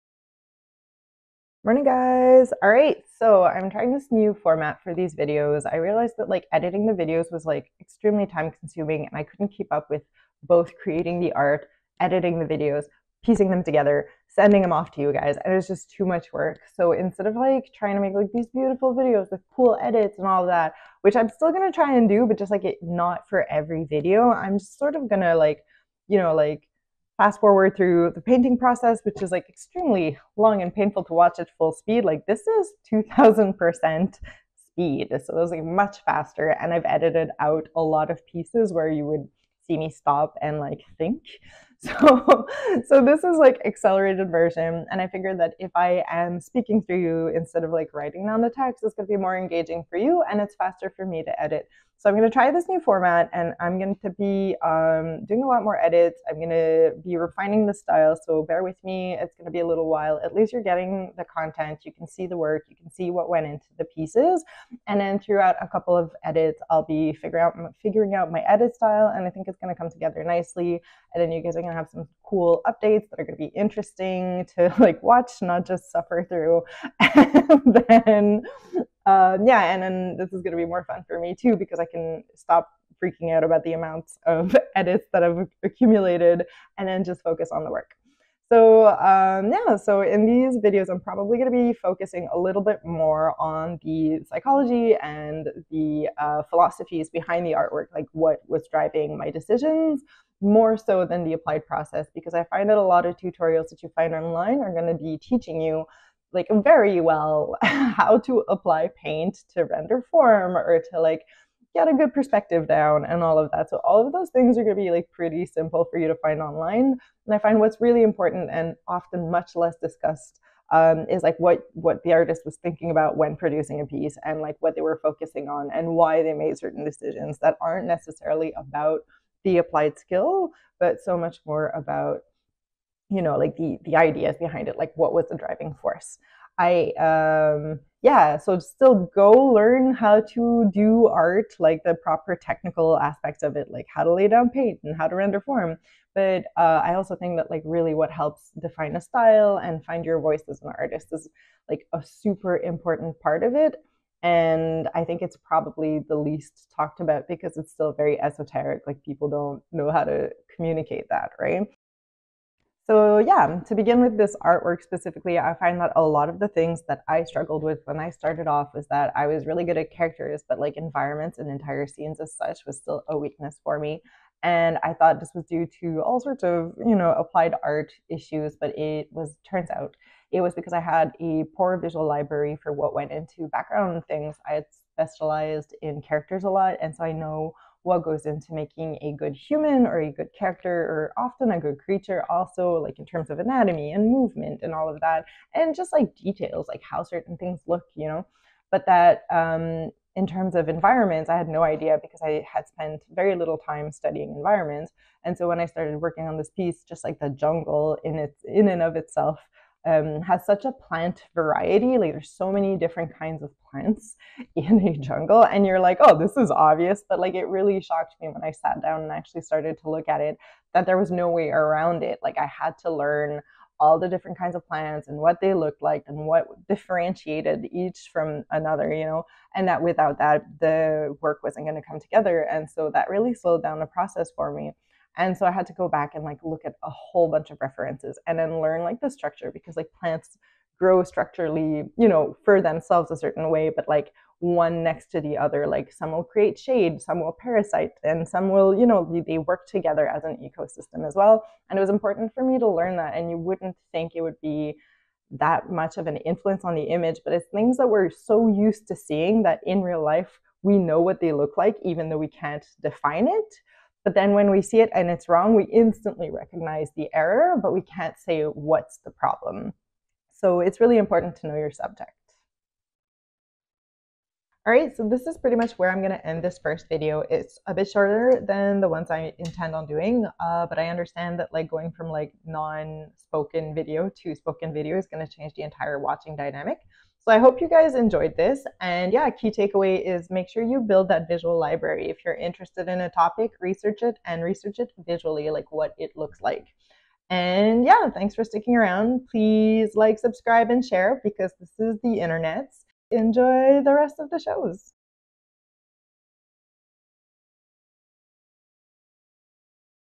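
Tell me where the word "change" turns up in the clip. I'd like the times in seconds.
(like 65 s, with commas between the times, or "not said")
285 s.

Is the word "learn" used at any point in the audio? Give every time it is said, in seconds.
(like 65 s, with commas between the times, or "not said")
139 s, 222 s, 238 s, 252 s.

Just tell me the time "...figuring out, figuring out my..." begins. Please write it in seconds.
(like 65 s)
67 s.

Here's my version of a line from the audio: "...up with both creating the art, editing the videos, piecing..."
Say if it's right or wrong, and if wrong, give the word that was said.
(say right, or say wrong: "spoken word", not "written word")
right.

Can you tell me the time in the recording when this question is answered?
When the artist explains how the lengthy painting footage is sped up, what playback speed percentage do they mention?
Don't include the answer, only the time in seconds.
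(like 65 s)
32 s.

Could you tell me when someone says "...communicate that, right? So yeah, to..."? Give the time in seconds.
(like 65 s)
160 s.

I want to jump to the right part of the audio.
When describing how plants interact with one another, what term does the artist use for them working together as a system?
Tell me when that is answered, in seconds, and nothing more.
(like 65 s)
250 s.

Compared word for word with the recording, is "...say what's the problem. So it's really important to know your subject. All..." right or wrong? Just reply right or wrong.
right.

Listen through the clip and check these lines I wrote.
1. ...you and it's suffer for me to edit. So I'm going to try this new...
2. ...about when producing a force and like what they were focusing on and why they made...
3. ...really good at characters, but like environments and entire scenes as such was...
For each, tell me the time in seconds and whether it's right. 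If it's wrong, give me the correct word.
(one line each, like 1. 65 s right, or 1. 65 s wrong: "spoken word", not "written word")
1. 49 s wrong: "faster", not "suffer"
2. 122 s wrong: "piece", not "force"
3. 169 s right.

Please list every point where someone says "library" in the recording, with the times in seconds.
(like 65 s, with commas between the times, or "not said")
182 s, 291 s.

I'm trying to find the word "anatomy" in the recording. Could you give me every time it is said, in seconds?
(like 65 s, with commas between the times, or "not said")
193 s.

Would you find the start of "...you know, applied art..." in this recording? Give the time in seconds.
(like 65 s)
176 s.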